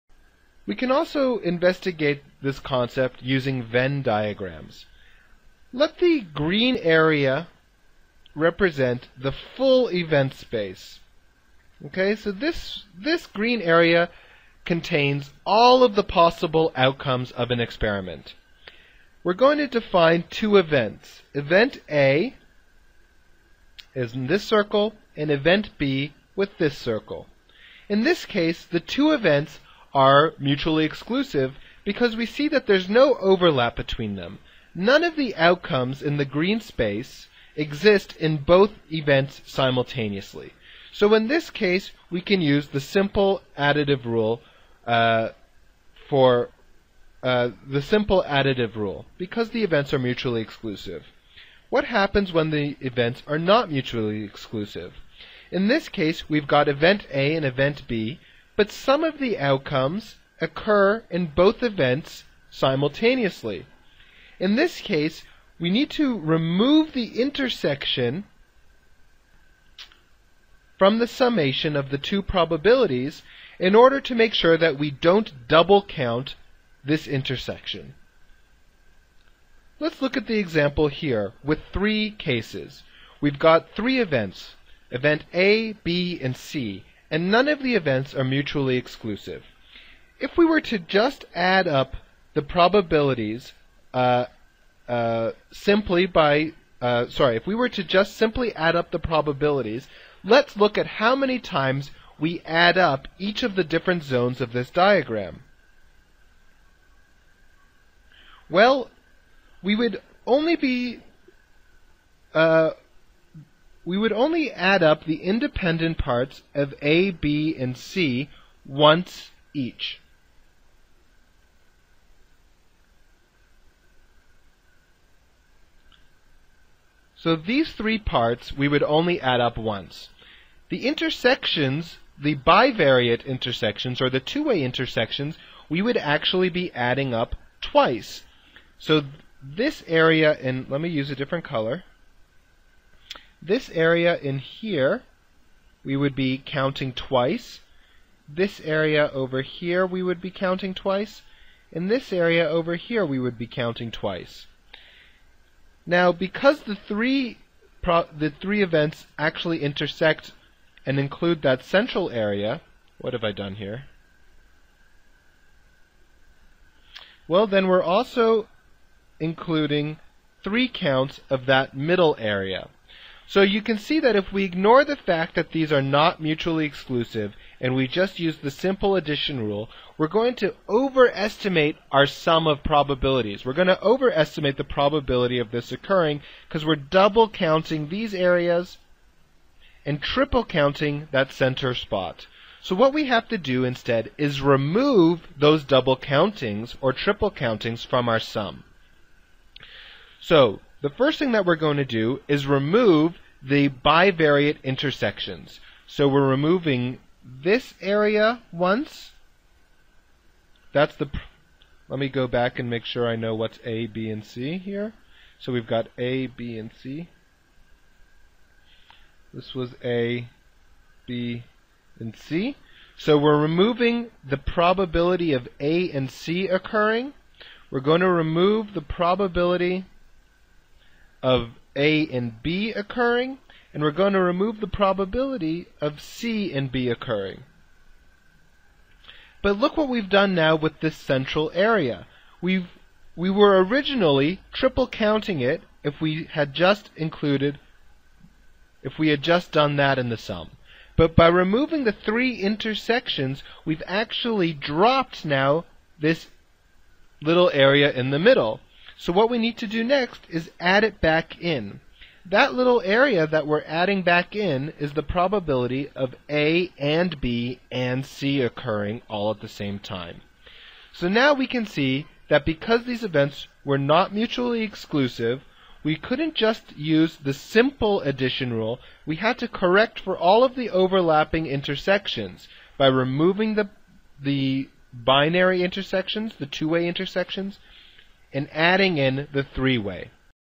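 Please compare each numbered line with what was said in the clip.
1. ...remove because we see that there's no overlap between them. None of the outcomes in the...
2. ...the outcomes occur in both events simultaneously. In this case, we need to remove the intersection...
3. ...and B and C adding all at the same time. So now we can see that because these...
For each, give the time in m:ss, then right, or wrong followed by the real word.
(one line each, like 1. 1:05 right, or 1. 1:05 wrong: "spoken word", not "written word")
1. 0:30 wrong: "exclusive", not "remove"
2. 0:59 right
3. 4:26 wrong: "occurring", not "adding".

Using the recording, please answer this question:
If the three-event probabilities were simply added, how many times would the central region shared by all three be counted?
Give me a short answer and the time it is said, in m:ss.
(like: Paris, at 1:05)
3, at 2:50.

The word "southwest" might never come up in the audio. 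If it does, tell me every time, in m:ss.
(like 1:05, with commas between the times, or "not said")
not said.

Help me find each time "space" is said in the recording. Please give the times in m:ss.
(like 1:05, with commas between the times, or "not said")
0:10, 0:36.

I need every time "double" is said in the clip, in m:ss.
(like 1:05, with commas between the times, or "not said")
1:15, 3:06, 3:15.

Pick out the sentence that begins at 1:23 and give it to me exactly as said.
We've got three events, event A, B, and C, and none of the events are mutually exclusive.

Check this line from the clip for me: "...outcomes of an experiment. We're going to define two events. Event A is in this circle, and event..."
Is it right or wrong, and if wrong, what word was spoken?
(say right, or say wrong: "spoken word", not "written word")
right.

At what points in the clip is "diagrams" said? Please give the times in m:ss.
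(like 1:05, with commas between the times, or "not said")
0:04, 1:44.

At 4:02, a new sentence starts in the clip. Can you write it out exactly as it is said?
We've, we were originally triple counting it if we had just included, if we had just done that in the sum.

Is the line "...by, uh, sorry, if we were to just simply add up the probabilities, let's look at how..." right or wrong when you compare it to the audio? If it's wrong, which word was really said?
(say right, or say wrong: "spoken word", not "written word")
right.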